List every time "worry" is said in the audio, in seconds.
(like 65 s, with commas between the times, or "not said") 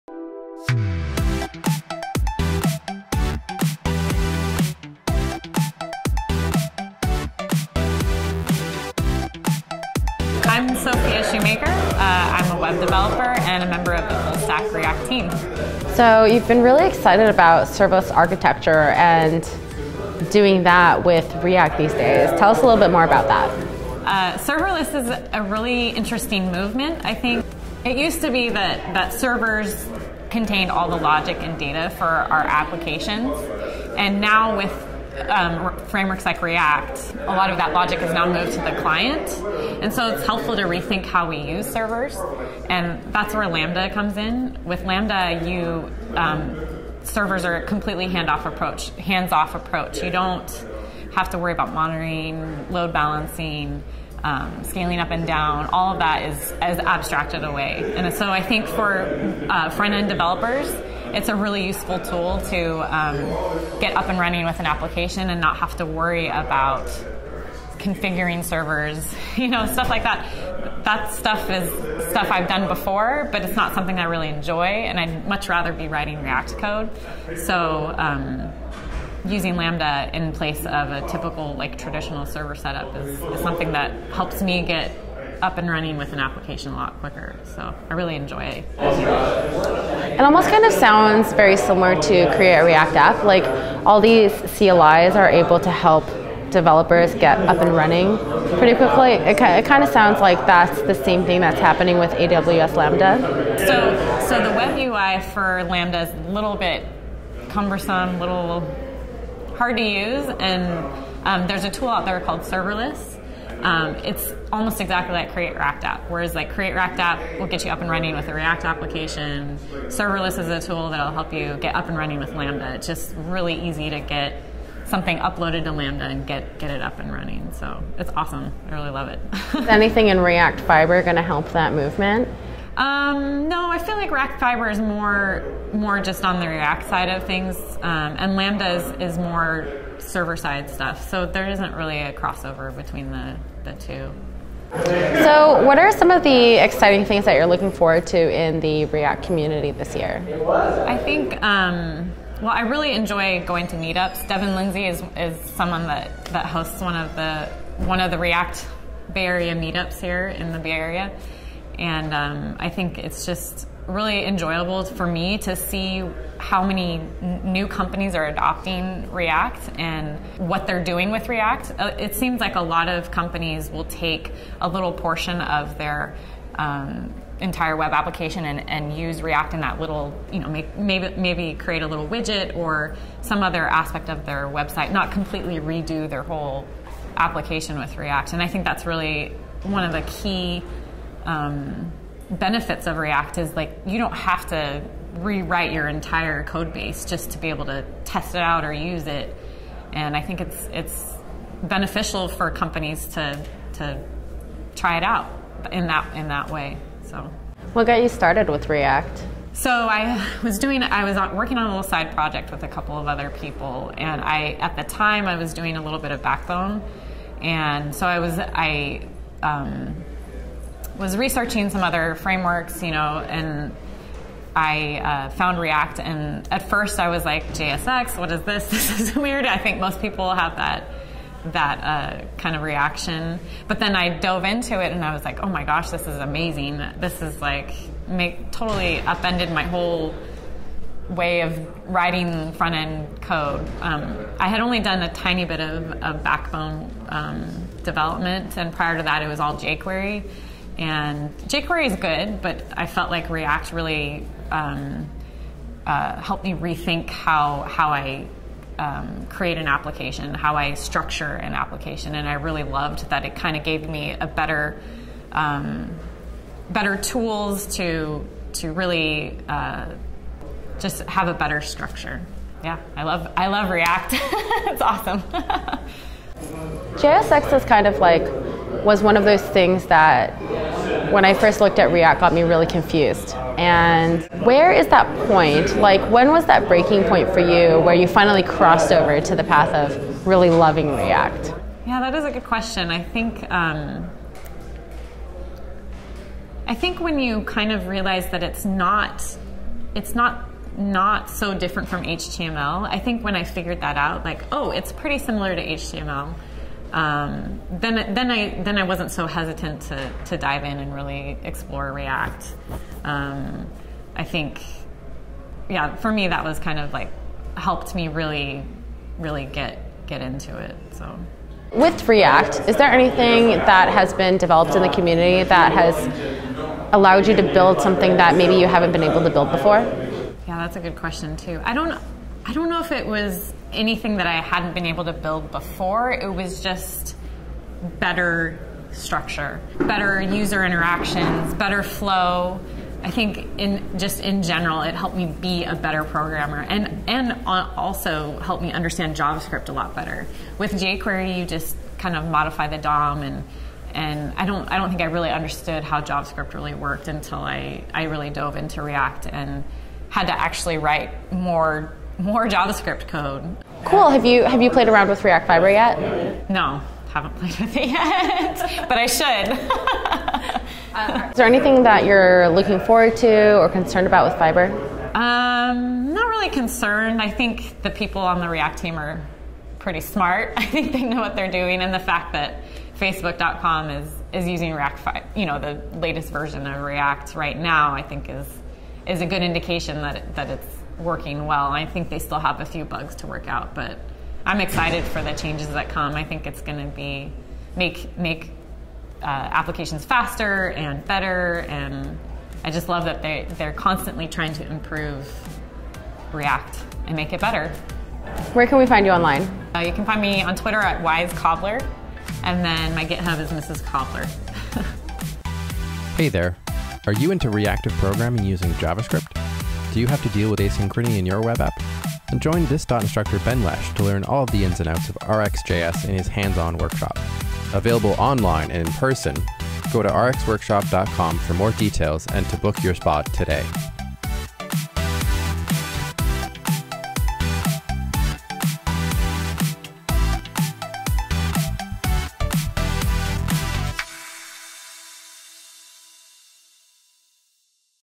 51 s, 65 s.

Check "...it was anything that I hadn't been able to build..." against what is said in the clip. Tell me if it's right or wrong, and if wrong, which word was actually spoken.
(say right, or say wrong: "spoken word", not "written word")
right.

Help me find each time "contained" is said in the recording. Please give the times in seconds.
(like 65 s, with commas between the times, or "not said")
30 s.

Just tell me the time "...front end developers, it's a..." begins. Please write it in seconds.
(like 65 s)
59 s.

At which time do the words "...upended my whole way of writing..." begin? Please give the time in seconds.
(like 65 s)
238 s.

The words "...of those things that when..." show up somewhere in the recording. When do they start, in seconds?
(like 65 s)
279 s.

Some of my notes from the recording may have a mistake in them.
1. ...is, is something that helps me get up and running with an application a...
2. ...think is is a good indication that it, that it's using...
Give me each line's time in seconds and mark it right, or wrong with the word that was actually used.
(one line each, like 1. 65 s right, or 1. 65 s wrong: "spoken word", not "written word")
1. 82 s right
2. 388 s wrong: "working", not "using".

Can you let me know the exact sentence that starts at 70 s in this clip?
That stuff is stuff I've done before, but it's not something I really enjoy, and I'd much rather be writing React code.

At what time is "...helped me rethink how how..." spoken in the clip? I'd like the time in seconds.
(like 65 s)
256 s.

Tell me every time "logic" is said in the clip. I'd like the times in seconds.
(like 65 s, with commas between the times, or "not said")
30 s, 37 s.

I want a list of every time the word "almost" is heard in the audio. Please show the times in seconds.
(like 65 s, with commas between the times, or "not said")
90 s, 114 s.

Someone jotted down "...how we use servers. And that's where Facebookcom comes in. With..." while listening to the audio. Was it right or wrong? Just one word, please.
wrong.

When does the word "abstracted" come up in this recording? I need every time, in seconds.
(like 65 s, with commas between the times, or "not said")
56 s.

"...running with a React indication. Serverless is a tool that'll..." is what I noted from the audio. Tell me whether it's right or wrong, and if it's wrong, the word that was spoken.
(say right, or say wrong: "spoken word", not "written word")
wrong: "application", not "indication".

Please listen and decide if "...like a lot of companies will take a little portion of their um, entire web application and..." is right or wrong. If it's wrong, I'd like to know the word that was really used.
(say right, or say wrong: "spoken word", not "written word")
right.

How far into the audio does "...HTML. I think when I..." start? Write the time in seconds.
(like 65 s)
302 s.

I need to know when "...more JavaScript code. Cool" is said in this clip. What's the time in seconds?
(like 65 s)
362 s.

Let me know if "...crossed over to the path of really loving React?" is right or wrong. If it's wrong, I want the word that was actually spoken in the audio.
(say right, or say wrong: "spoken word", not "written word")
right.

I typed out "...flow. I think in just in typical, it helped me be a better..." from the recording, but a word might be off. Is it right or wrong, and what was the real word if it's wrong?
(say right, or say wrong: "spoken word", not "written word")
wrong: "general", not "typical".